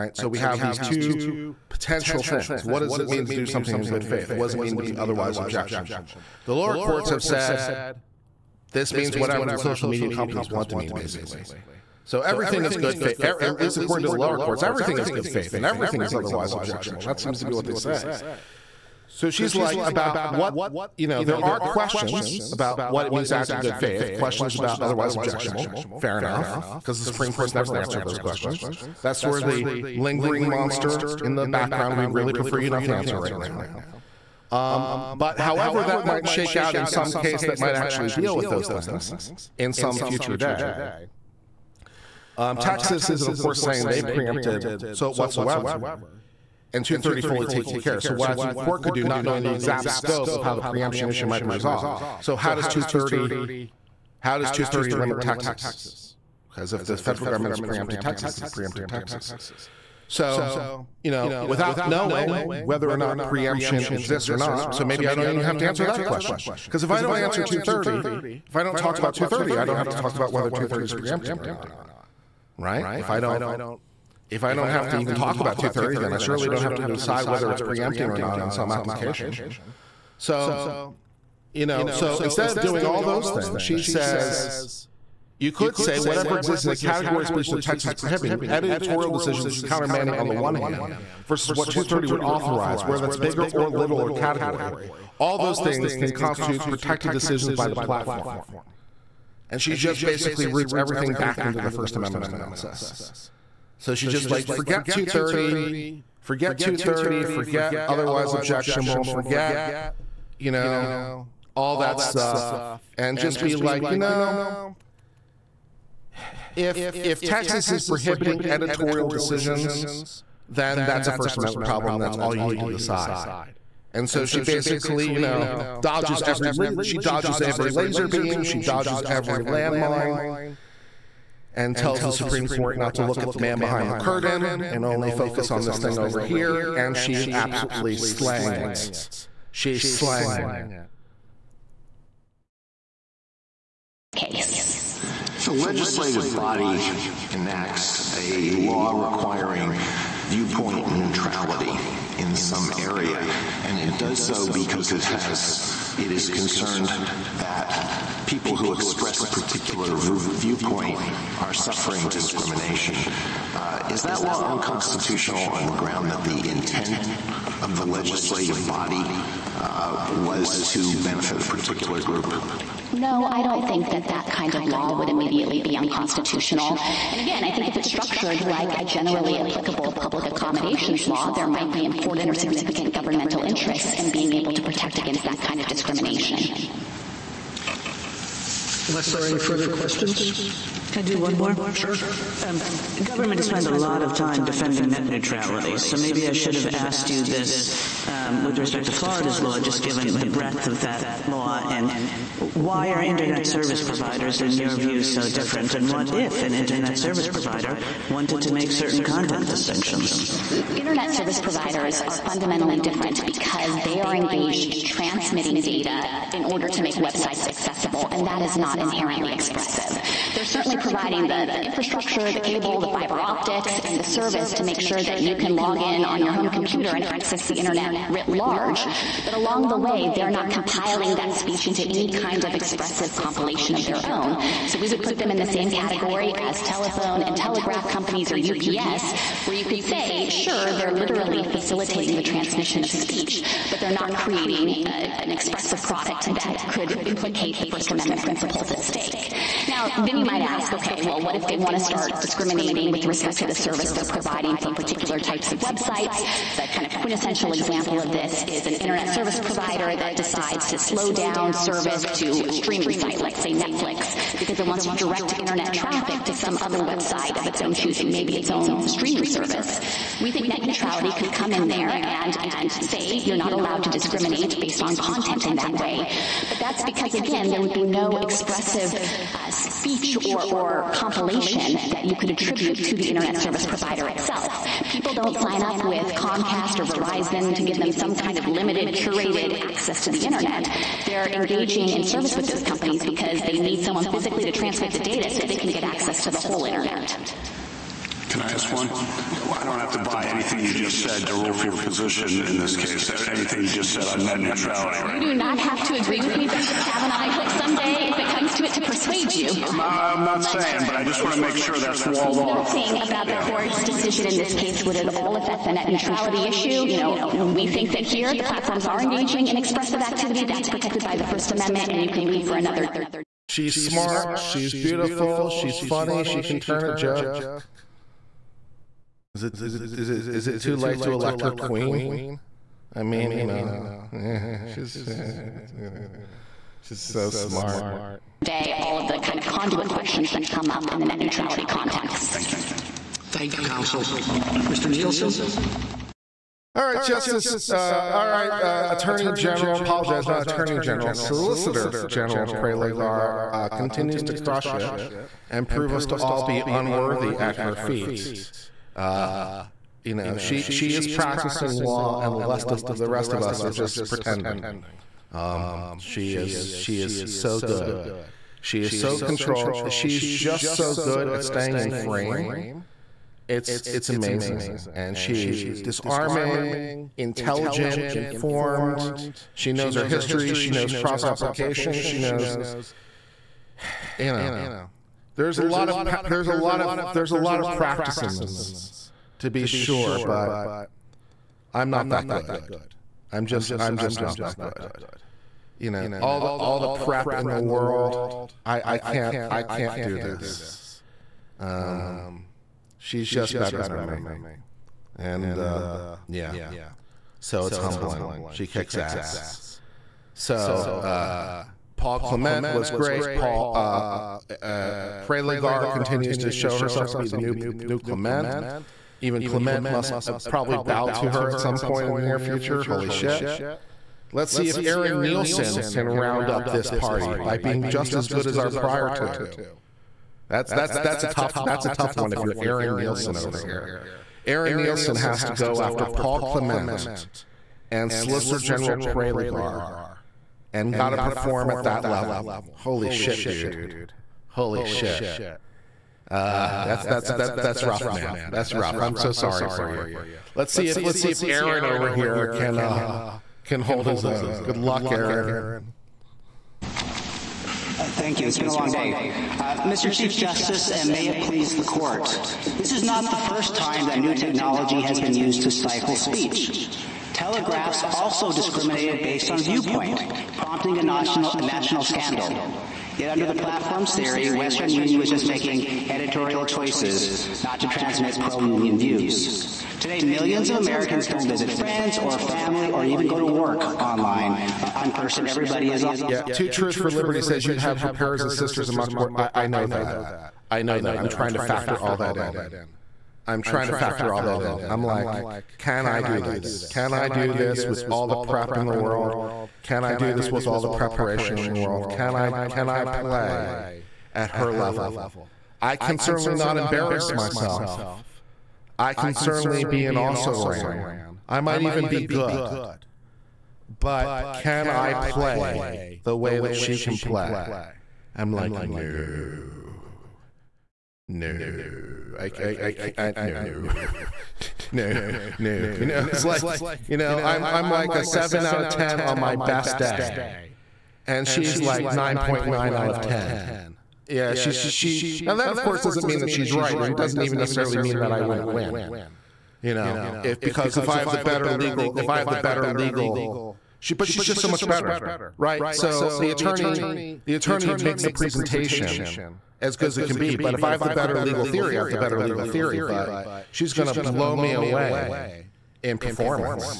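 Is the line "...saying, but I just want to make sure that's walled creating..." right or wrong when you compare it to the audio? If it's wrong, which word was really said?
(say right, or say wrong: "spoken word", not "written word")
wrong: "nothing", not "creating".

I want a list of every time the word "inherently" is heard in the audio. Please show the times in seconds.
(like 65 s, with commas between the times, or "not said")
218 s.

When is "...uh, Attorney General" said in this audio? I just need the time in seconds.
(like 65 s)
348 s.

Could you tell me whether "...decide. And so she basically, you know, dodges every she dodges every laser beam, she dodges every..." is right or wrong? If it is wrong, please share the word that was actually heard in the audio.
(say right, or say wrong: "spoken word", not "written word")
right.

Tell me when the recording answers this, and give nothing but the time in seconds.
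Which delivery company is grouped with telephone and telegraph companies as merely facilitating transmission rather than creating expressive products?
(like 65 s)
238 s.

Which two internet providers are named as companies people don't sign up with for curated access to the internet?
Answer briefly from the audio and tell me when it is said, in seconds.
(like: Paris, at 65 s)
Comcast or Verizon, at 286 s.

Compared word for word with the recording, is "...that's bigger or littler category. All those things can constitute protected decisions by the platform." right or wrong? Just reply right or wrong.
right.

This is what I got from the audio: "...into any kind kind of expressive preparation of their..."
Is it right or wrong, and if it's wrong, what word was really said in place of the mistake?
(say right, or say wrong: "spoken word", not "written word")
wrong: "compilation", not "preparation".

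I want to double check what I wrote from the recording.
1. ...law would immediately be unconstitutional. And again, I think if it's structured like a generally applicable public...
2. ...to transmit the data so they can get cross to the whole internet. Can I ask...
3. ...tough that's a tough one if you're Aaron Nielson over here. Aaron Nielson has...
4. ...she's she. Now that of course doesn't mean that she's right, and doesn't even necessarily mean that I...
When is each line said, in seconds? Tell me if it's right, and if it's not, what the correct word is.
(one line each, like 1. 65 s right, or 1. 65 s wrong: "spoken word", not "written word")
1. 174 s right
2. 294 s wrong: "access", not "cross"
3. 431 s right
4. 534 s right.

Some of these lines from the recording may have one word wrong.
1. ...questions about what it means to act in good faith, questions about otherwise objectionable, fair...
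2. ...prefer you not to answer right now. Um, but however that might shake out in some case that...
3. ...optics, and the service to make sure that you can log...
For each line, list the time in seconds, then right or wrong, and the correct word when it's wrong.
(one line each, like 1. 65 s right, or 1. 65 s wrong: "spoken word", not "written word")
1. 21 s right
2. 32 s right
3. 223 s right.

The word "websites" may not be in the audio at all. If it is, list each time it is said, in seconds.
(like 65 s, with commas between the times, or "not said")
216 s, 255 s, 266 s.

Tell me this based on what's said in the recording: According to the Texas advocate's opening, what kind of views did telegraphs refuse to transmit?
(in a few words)
Pro-union views.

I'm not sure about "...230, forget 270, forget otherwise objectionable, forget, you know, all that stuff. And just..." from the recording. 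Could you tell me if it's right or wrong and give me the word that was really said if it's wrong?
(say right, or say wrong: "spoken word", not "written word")
wrong: "230", not "270".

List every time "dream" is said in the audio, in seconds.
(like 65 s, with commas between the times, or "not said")
not said.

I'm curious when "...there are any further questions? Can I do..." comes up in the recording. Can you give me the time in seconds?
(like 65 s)
189 s.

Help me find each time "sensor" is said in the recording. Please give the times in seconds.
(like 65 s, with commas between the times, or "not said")
not said.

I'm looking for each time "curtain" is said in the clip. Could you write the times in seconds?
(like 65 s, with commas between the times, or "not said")
133 s.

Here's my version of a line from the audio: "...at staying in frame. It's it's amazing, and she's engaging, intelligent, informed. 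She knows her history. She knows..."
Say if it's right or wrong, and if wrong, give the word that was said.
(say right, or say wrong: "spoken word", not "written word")
wrong: "disarming", not "engaging".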